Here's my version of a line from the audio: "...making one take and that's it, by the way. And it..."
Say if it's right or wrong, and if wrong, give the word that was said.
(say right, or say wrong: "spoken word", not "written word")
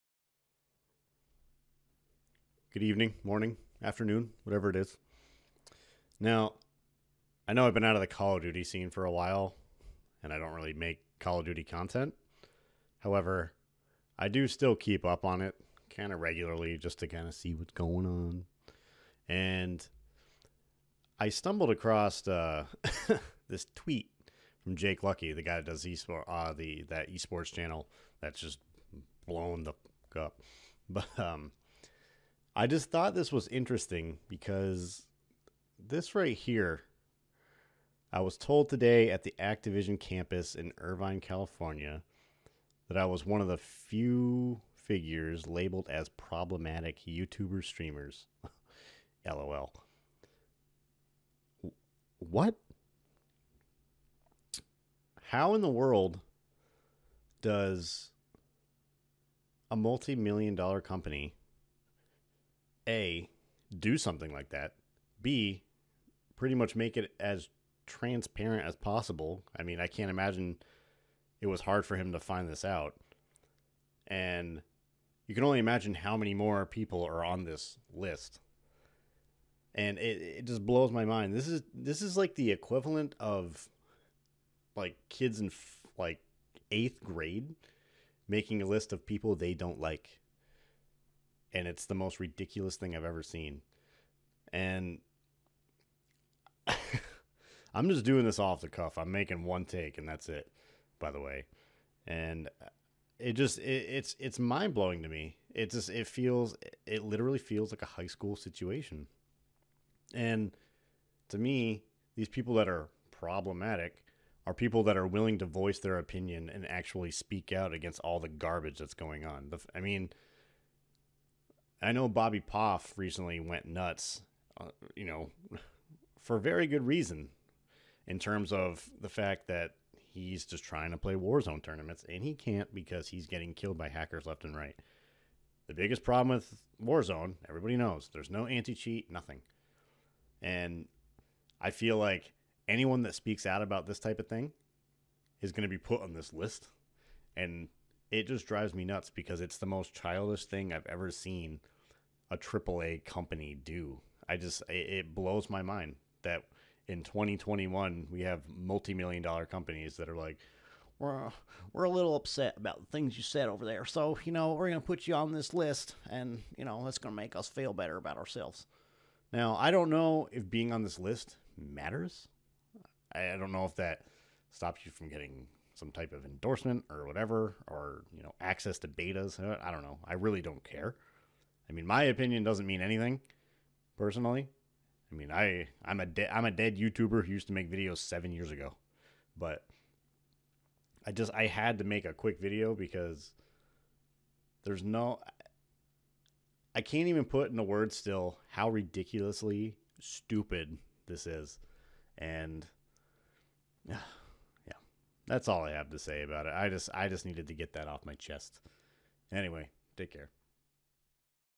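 right.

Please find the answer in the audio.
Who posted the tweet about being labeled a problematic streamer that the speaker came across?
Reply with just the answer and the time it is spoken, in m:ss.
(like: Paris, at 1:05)
Jake Lucky, at 0:24.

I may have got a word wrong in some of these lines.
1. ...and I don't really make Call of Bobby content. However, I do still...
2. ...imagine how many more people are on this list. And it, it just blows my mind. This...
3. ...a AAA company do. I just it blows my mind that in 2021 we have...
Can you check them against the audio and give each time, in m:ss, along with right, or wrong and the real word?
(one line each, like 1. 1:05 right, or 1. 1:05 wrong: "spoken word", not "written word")
1. 0:10 wrong: "Duty", not "Bobby"
2. 1:15 right
3. 2:32 right.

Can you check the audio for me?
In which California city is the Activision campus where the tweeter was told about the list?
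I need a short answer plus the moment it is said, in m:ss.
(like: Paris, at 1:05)
Irvine, at 0:40.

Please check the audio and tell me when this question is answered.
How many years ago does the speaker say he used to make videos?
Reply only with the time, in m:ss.
3:07.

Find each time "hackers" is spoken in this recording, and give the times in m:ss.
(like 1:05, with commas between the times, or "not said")
2:13.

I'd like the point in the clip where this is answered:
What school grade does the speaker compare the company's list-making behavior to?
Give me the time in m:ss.
1:26.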